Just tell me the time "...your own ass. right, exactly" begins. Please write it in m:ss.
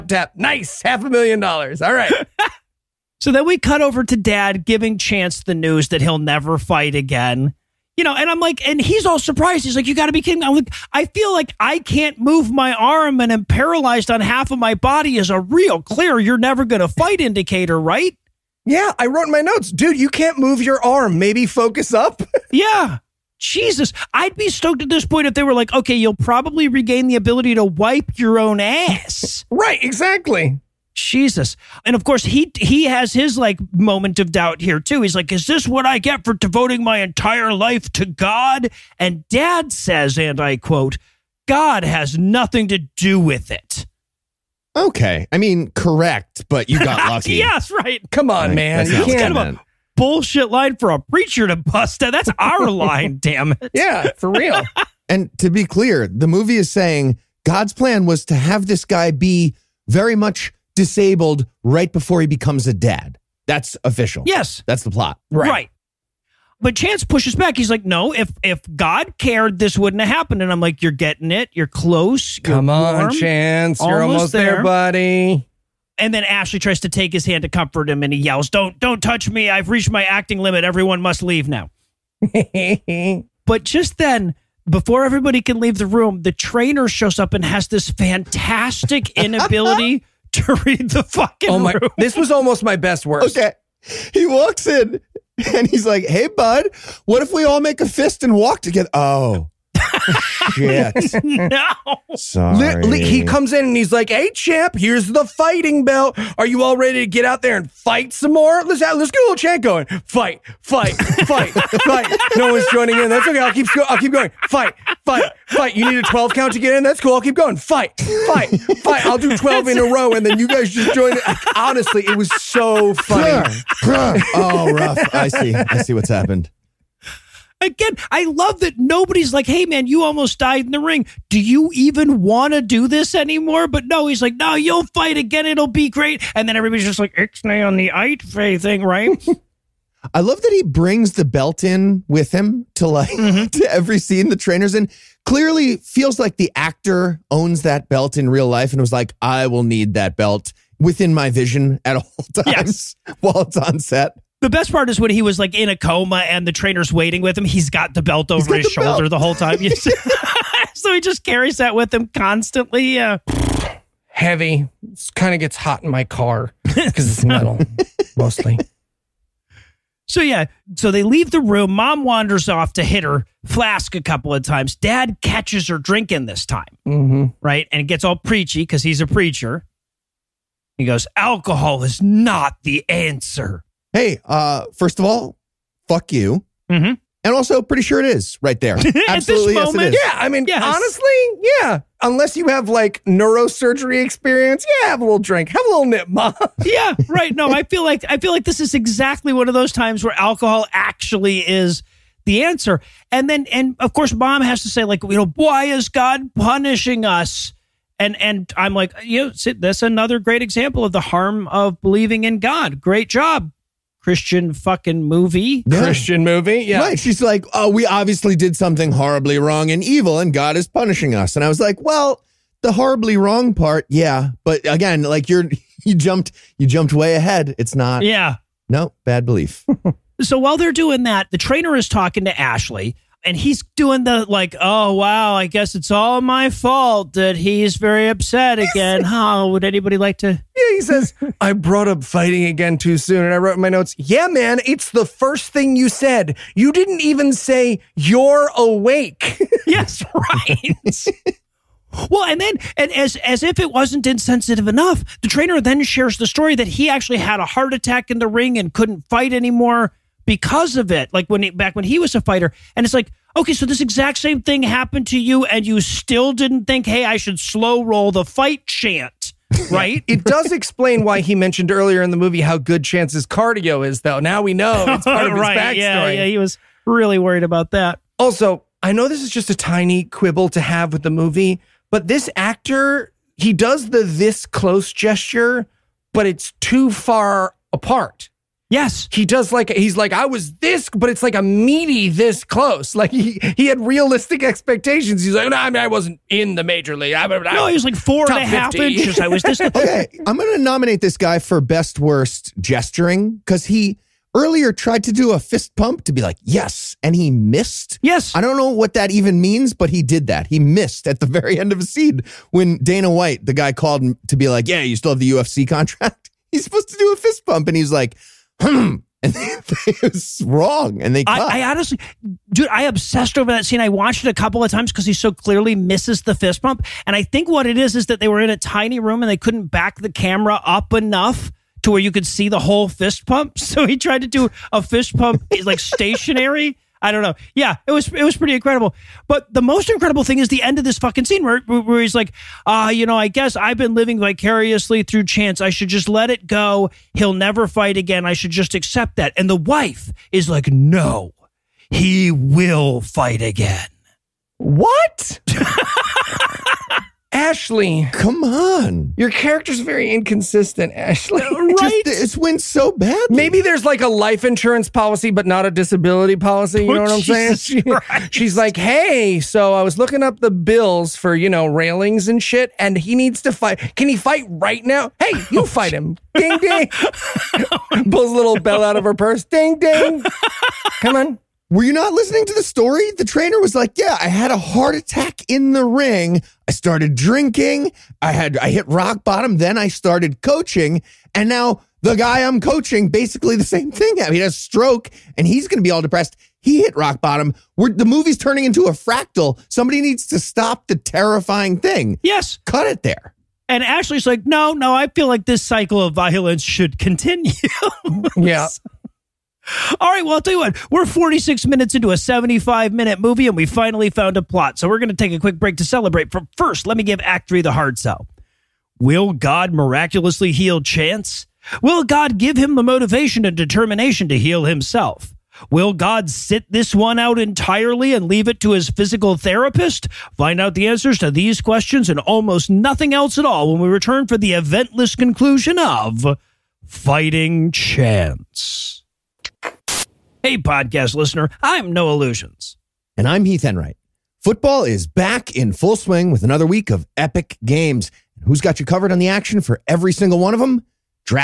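0:28.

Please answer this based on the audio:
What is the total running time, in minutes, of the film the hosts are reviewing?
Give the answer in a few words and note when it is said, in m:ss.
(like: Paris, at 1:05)
75, at 6:52.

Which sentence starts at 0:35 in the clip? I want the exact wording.
He's like, is this what I get for devoting my entire life to God?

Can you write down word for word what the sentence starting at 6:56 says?
But first, let me give Act 3 the hard sell.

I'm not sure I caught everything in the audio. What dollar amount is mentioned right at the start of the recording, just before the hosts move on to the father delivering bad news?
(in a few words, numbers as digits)
Half a million dollars.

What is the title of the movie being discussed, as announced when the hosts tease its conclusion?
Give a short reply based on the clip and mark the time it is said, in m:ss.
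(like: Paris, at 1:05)
Fighting Chance, at 7:16.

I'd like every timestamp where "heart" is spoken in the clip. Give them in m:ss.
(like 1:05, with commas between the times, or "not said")
4:17, 6:24.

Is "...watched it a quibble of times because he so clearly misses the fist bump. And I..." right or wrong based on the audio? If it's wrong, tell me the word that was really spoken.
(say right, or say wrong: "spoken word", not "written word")
wrong: "couple", not "quibble".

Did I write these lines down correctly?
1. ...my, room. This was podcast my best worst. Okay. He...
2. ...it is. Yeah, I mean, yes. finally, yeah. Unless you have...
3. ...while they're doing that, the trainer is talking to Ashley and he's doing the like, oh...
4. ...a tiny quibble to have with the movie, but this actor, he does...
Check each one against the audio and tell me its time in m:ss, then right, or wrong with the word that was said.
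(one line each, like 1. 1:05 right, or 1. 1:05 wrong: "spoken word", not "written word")
1. 1:31 wrong: "almost", not "podcast"
2. 3:09 wrong: "honestly", not "finally"
3. 3:50 right
4. 4:39 right.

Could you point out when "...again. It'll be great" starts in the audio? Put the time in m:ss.
2:15.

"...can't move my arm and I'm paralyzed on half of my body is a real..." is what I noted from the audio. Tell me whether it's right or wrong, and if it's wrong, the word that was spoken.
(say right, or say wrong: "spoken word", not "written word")
right.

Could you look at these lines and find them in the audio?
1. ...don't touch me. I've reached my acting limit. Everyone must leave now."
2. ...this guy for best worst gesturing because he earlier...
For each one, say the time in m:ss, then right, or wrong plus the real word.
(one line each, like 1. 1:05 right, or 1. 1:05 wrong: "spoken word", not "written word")
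1. 1:18 right
2. 5:01 right.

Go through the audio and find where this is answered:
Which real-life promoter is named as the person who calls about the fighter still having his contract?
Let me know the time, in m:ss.
5:12.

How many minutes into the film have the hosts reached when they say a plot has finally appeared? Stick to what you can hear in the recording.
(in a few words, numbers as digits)
46.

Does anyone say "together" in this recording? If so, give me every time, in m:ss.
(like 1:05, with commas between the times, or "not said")
1:38.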